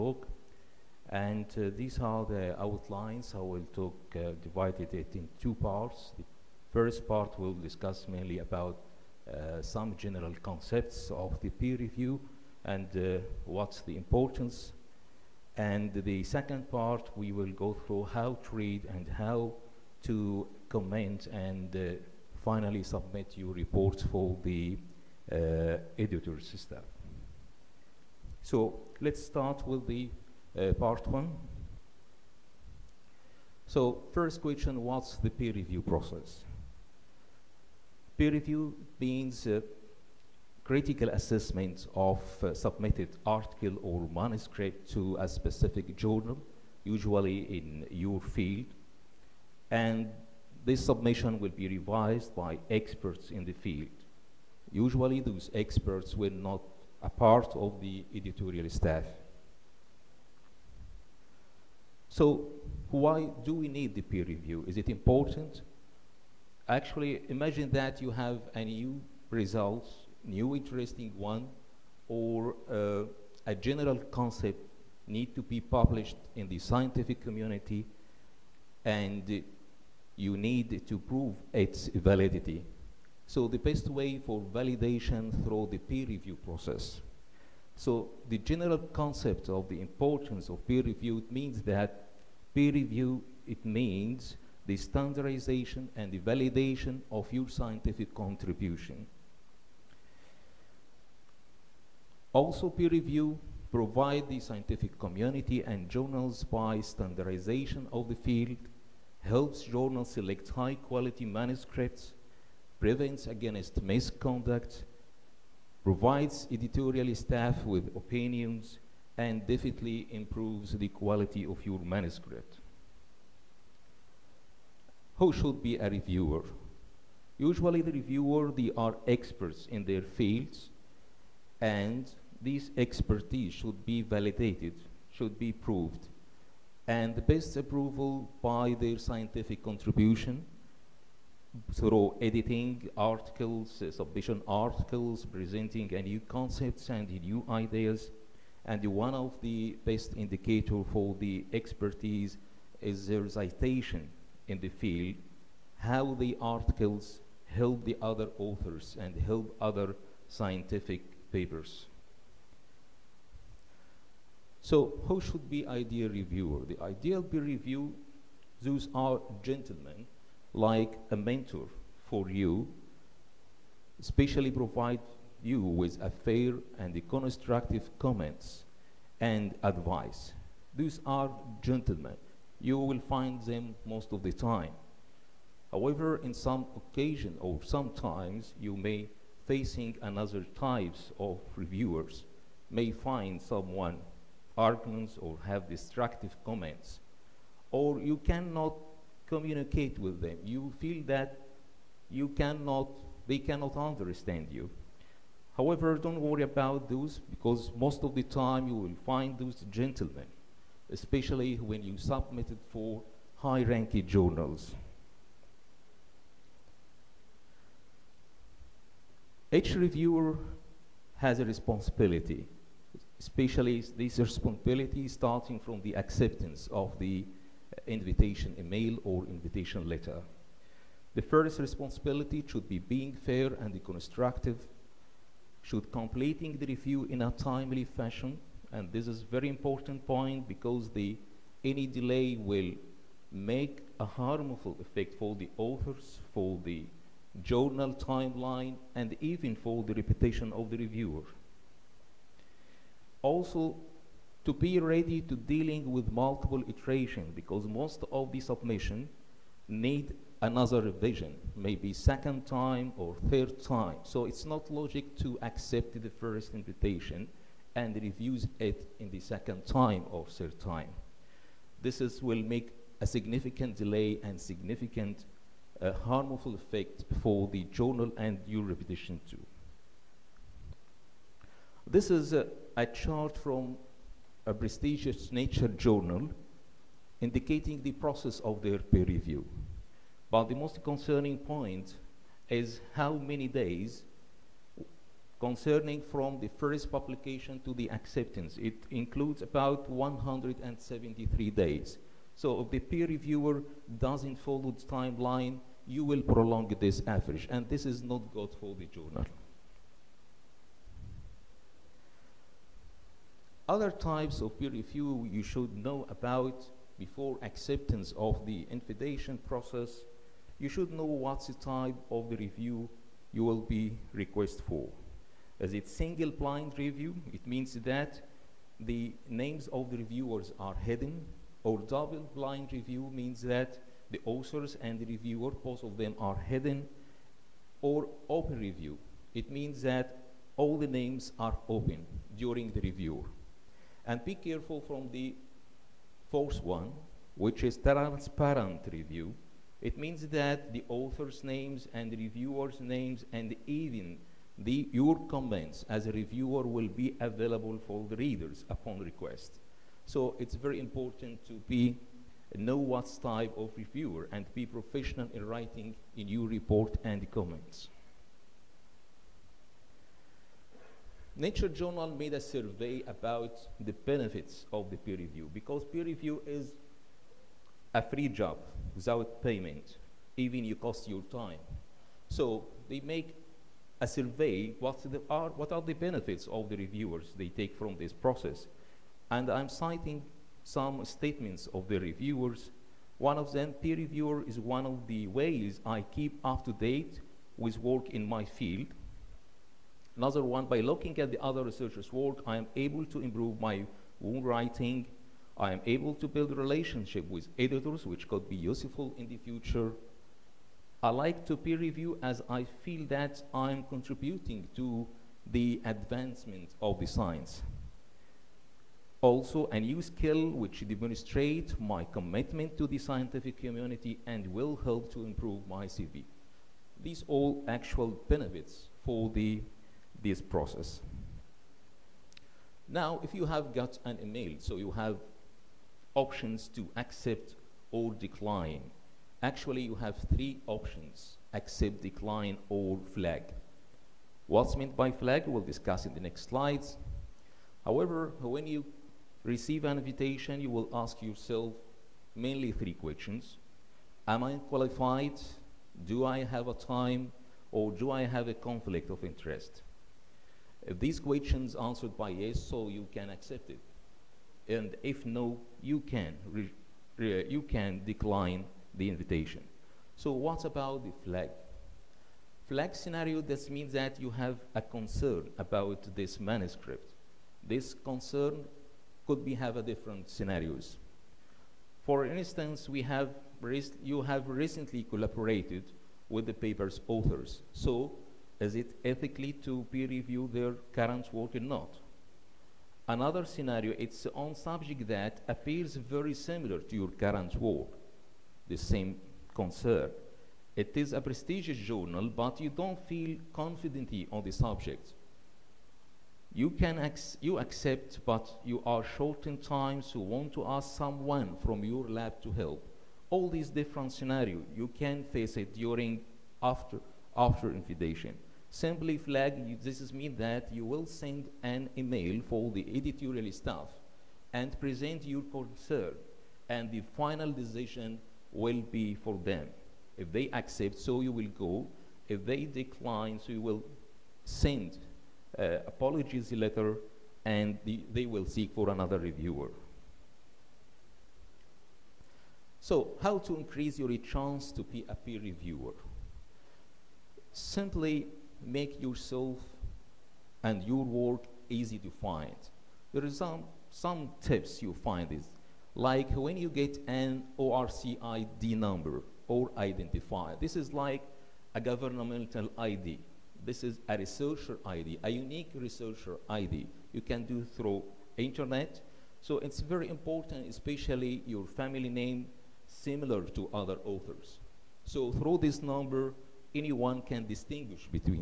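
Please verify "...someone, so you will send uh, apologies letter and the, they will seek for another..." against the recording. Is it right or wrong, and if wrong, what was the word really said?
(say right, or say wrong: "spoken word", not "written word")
wrong: "decline", not "someone".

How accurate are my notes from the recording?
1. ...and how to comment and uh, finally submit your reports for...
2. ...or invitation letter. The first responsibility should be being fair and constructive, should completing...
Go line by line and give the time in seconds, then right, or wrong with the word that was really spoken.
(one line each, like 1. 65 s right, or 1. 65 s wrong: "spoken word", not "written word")
1. 18 s right
2. 229 s right.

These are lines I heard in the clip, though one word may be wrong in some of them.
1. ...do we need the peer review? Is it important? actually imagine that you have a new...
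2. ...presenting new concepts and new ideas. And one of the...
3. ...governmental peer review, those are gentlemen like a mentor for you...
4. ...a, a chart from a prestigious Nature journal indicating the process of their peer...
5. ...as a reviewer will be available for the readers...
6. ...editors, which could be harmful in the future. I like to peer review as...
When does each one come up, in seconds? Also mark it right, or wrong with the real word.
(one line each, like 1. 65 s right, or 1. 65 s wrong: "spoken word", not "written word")
1. 63 s right
2. 145 s right
3. 166 s wrong: "ideal", not "governmental"
4. 282 s right
5. 355 s right
6. 407 s wrong: "useful", not "harmful".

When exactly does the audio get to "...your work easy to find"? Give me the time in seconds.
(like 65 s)
550 s.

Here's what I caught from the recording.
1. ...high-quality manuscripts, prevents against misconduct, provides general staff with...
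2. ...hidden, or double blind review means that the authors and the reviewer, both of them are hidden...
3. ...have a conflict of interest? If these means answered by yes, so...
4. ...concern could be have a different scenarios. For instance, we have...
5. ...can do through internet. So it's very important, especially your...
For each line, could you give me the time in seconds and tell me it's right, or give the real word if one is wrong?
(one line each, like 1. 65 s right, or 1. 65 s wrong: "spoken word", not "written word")
1. 110 s wrong: "editorial", not "general"
2. 330 s right
3. 458 s wrong: "questions", not "means"
4. 477 s right
5. 567 s right.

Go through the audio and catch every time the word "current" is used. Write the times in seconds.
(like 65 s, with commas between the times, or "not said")
490 s, 497 s.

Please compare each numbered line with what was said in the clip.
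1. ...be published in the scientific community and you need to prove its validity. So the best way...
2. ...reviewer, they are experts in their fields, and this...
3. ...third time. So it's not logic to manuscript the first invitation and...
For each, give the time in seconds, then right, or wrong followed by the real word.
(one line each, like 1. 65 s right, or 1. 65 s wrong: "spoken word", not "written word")
1. 75 s right
2. 127 s right
3. 263 s wrong: "accept", not "manuscript".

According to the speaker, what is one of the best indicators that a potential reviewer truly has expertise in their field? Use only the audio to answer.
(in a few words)
Citation in the field.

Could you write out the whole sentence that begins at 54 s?
Usually those experts were not a part of the editorial staff.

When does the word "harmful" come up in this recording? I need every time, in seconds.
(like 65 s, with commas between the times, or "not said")
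244 s, 275 s.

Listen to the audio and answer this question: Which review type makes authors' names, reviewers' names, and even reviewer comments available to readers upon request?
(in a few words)
Transparent review.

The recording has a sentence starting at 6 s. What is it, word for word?
The first part will discuss mainly about uh, some general concepts of the peer review and uh, what's the importance.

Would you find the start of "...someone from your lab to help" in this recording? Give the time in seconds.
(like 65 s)
510 s.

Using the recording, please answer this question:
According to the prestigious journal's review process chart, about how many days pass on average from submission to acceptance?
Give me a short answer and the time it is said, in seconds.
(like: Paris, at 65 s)
173 days, at 299 s.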